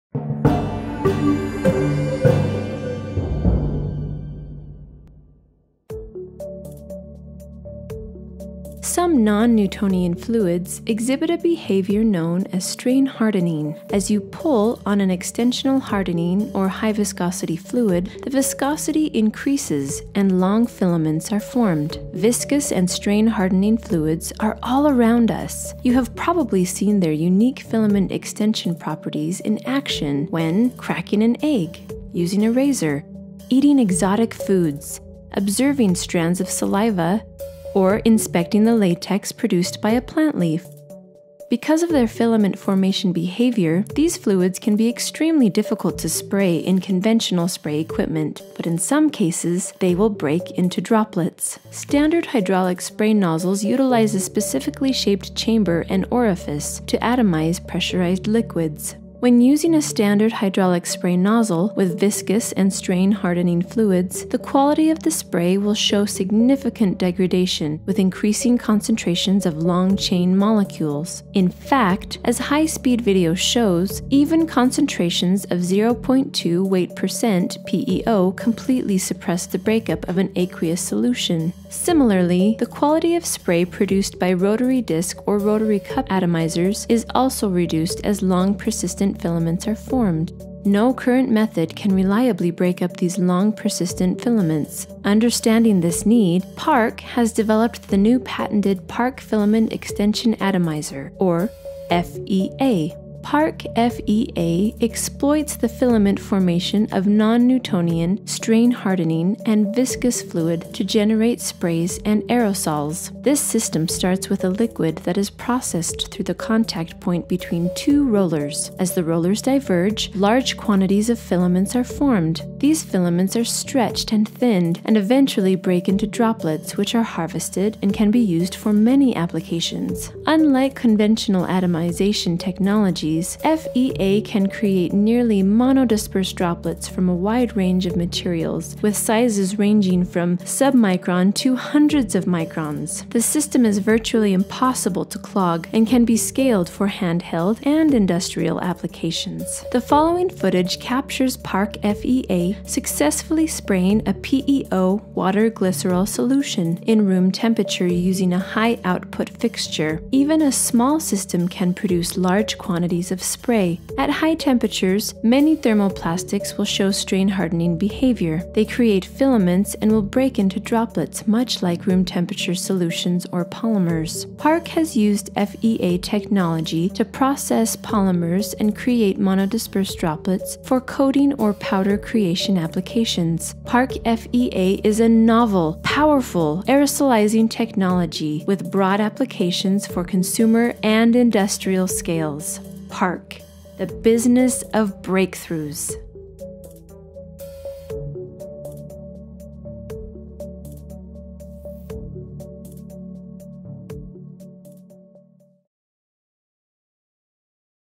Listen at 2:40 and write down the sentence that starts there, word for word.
Even a small system can produce large quantities of spray.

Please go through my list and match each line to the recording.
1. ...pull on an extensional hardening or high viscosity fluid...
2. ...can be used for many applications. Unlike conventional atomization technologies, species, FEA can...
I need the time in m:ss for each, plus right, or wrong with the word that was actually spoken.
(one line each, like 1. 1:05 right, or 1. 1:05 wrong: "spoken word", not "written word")
1. 0:14 right
2. 2:07 right.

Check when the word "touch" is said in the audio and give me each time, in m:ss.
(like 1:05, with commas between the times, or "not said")
not said.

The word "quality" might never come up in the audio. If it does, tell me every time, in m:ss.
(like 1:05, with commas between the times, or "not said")
1:04, 1:22.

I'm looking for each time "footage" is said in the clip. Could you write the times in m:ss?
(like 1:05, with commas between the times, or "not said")
2:30.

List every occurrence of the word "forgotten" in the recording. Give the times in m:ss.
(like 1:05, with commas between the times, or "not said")
not said.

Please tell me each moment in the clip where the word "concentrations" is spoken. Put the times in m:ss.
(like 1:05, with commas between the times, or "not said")
1:08, 1:14.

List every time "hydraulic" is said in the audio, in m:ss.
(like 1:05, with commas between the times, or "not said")
0:52, 1:00.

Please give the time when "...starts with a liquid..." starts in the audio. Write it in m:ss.
1:53.